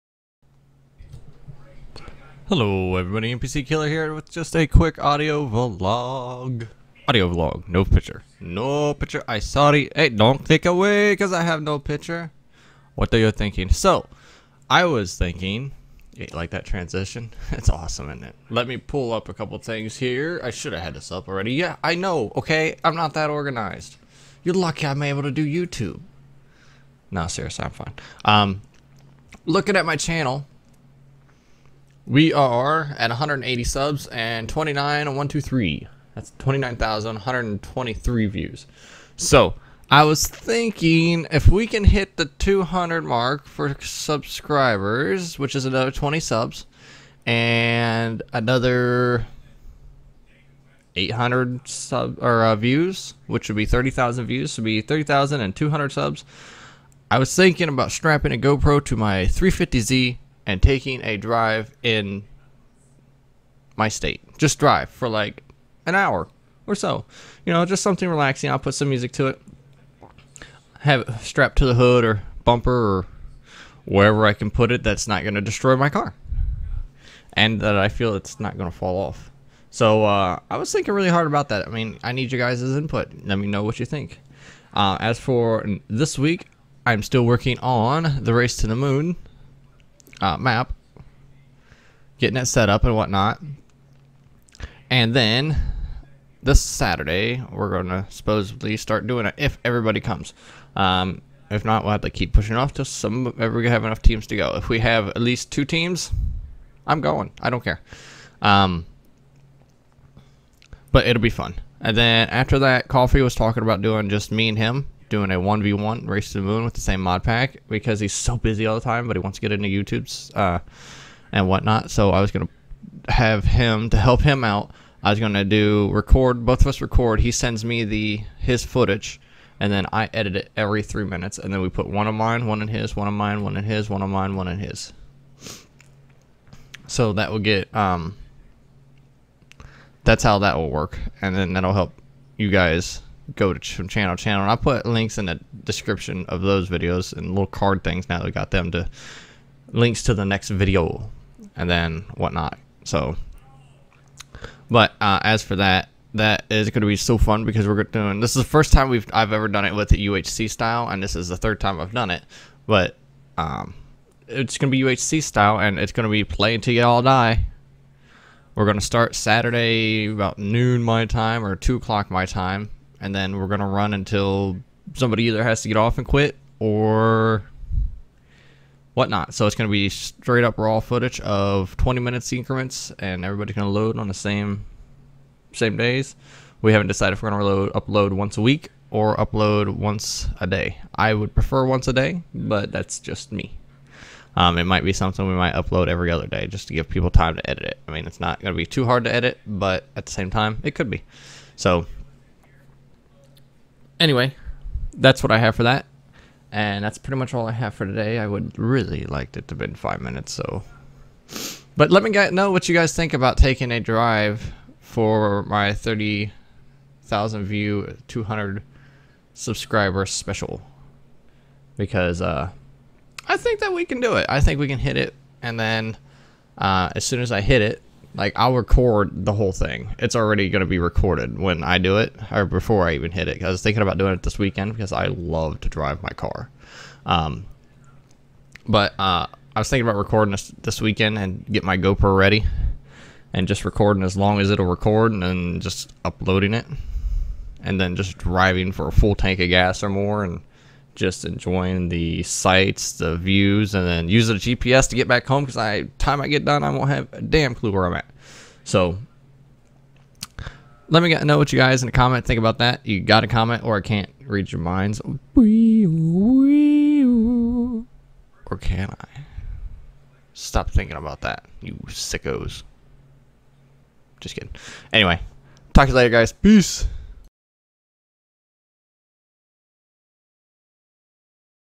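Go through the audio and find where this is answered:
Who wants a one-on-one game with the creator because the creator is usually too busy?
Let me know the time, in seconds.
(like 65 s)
112 s.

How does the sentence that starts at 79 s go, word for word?
So uh, I was thinking really hard about that.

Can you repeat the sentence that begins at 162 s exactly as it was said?
But um, it's going to be UHC style, and it's going to be play until you all die.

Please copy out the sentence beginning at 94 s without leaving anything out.
And then this Saturday, we're going to supposedly start doing it if everybody comes.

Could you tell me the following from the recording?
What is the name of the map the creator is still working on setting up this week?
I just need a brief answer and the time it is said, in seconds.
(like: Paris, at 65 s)
The Race to the Moon, at 88 s.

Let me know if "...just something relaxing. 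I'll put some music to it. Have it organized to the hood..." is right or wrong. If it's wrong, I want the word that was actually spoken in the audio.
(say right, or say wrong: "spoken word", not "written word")
wrong: "strapped", not "organized".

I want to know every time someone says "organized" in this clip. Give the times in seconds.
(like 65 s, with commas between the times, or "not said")
23 s.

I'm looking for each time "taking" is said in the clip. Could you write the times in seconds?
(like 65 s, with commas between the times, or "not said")
60 s, 213 s.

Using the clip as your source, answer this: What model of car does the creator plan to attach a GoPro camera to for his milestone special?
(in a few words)
350Z.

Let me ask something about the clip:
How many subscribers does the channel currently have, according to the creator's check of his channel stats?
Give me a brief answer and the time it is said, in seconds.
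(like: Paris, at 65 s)
180, at 33 s.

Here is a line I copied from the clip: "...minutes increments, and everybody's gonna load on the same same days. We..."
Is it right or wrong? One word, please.
right.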